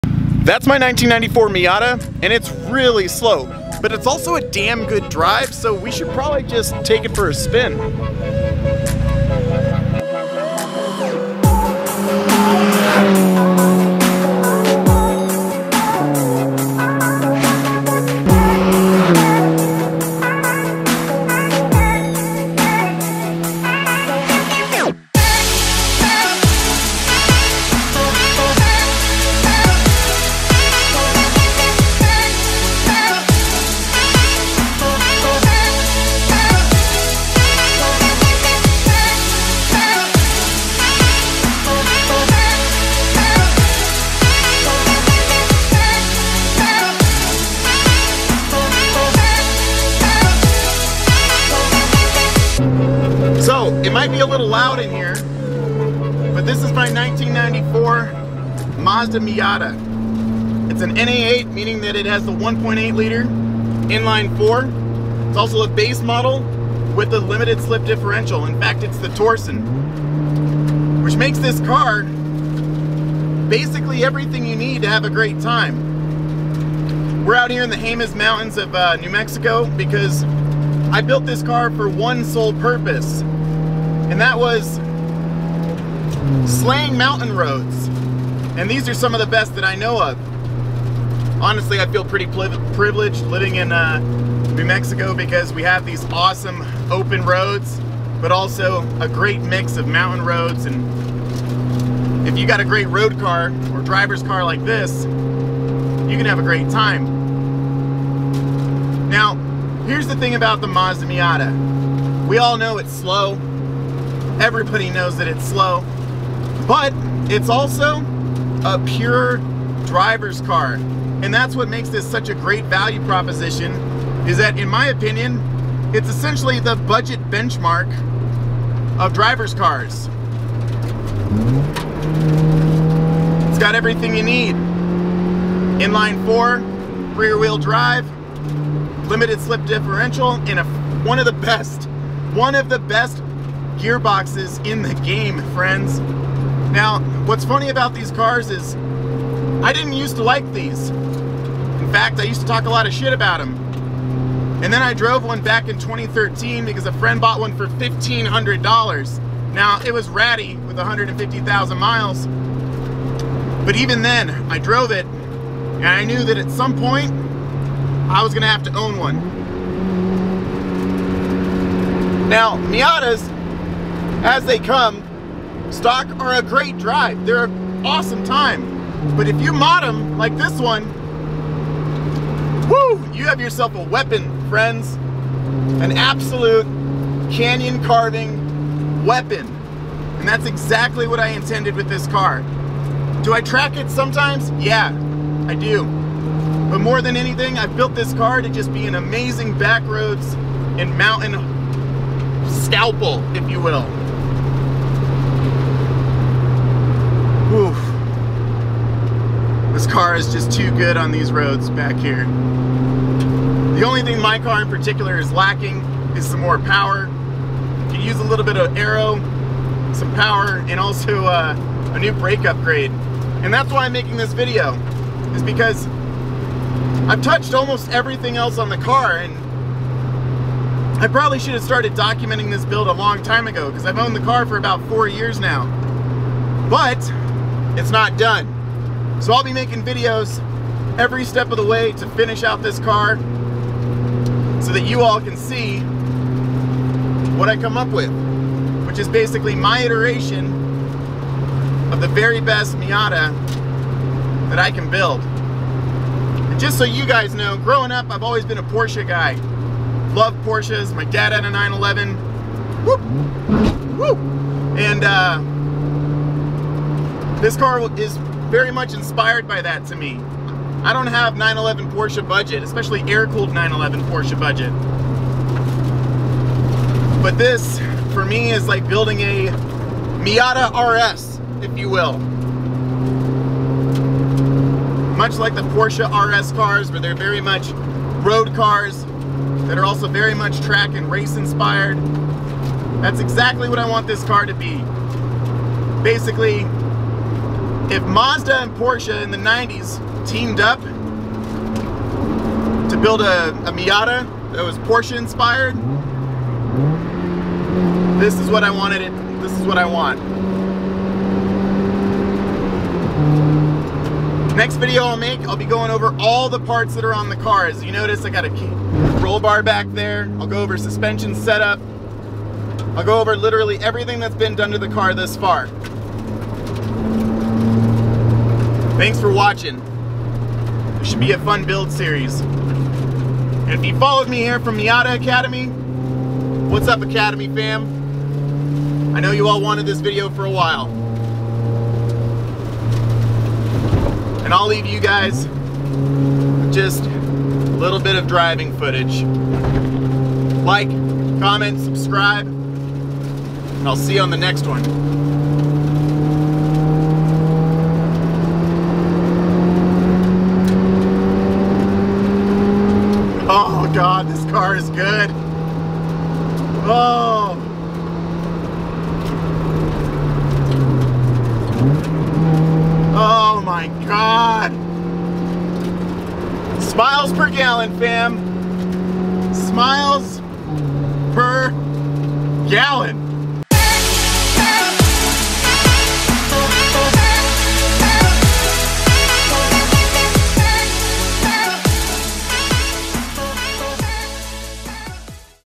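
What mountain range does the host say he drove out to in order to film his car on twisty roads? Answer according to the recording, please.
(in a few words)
Jemez Mountains.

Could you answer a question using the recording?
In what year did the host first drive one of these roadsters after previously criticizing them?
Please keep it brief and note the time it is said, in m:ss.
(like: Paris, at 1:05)
2013, at 2:35.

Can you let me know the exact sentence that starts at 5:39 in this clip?
I know you all wanted this video for a while.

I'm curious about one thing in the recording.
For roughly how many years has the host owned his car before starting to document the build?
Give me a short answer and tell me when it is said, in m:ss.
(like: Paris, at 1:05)
4, at 3:54.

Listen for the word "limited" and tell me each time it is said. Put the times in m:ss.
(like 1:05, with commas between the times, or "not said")
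1:07, 2:19.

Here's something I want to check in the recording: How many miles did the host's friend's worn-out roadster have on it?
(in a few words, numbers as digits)
150,000.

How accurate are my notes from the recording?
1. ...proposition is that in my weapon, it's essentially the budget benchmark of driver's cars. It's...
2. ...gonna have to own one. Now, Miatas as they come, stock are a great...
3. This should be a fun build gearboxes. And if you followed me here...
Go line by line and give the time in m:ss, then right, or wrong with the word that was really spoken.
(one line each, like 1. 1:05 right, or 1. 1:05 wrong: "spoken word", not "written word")
1. 2:03 wrong: "opinion", not "weapon"
2. 2:48 right
3. 5:30 wrong: "series", not "gearboxes".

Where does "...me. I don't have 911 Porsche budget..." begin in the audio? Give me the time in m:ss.
4:29.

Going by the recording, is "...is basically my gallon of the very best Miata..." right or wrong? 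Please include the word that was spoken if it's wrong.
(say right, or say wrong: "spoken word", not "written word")
wrong: "iteration", not "gallon".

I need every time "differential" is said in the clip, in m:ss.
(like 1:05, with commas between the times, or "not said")
1:07, 2:19.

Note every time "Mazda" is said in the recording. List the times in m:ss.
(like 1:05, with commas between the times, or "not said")
0:58, 1:50, 4:58.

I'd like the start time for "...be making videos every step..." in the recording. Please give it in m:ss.
3:59.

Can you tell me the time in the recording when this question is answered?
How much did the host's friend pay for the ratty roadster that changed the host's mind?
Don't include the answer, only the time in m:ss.
2:37.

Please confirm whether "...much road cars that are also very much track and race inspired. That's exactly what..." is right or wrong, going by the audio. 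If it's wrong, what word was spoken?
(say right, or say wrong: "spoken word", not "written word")
right.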